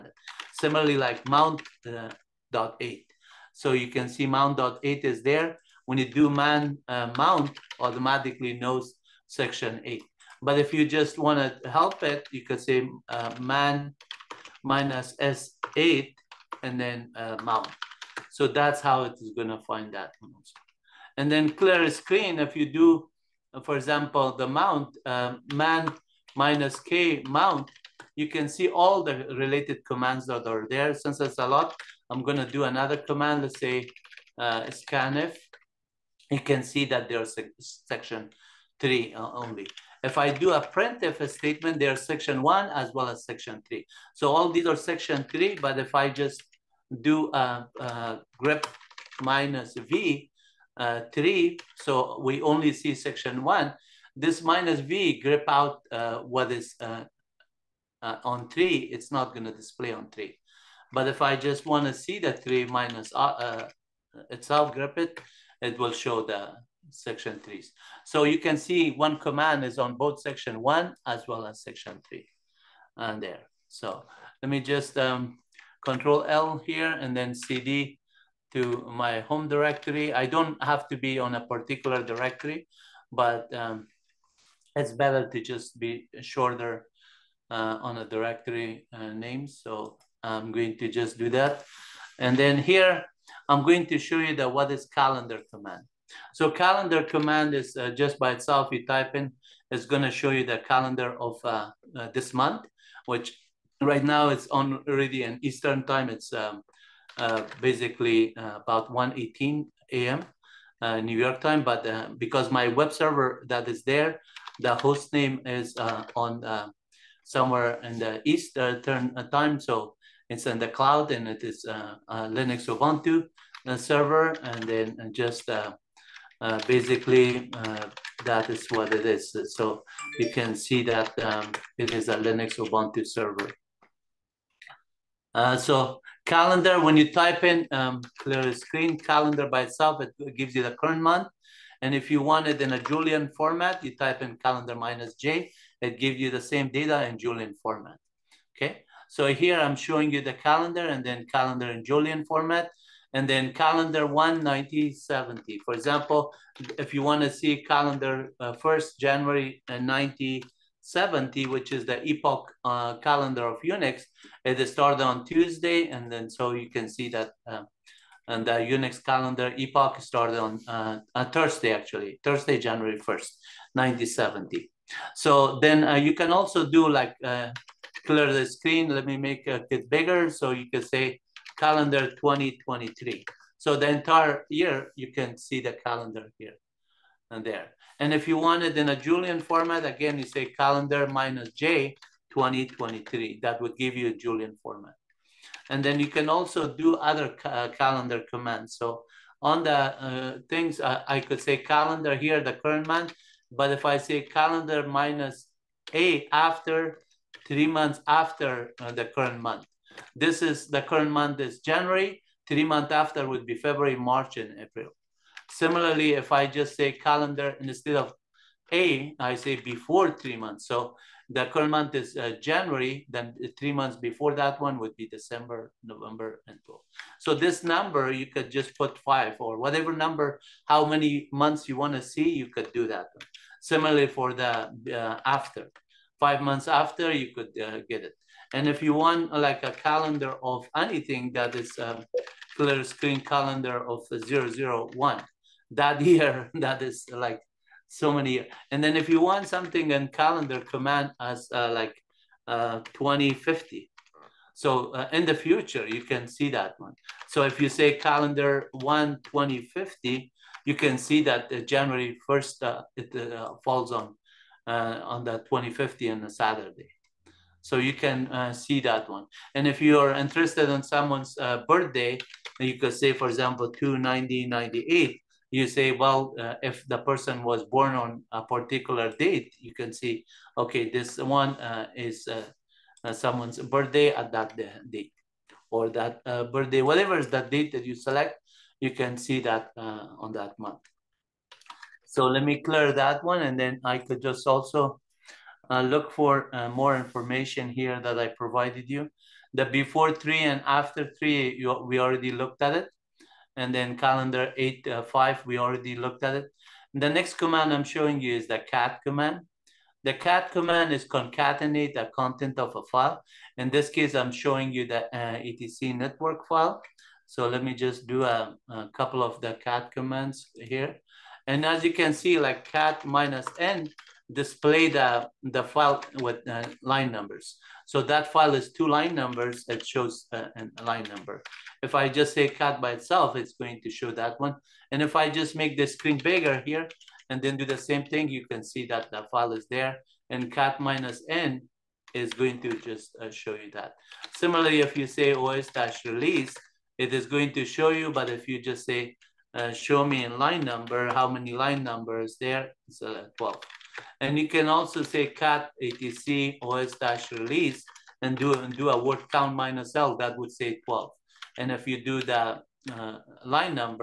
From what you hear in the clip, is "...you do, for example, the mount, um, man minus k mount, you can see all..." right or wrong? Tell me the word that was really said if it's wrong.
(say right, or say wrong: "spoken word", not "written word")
right.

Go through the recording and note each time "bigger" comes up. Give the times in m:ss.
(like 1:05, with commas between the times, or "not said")
2:59, 5:36.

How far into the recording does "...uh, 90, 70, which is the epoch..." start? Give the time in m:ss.
2:39.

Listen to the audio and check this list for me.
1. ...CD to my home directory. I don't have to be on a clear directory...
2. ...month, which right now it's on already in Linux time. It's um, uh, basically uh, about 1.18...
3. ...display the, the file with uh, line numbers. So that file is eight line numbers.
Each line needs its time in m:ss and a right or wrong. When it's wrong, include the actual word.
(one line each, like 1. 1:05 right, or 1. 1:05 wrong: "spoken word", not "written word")
1. 1:17 wrong: "particular", not "clear"
2. 1:42 wrong: "Eastern", not "Linux"
3. 5:24 wrong: "two", not "eight".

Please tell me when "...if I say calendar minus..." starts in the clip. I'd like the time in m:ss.
3:23.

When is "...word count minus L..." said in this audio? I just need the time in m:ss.
5:59.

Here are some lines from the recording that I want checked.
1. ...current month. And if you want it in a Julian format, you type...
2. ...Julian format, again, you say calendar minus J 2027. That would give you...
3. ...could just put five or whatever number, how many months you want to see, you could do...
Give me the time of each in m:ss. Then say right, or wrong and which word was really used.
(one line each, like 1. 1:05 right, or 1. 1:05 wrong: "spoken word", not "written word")
1. 2:20 right
2. 3:08 wrong: "2023", not "2027"
3. 3:48 right.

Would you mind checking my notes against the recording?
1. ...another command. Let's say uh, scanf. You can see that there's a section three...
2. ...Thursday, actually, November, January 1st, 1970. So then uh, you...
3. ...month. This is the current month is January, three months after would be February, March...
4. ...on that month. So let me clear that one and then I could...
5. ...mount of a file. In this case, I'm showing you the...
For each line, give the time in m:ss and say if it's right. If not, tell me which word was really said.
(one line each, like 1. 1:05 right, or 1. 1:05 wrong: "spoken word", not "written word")
1. 0:32 right
2. 2:51 wrong: "Thursday", not "November"
3. 3:29 right
4. 4:50 right
5. 5:12 wrong: "content", not "mount".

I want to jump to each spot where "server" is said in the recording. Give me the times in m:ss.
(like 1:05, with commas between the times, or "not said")
1:52, 2:03, 2:13.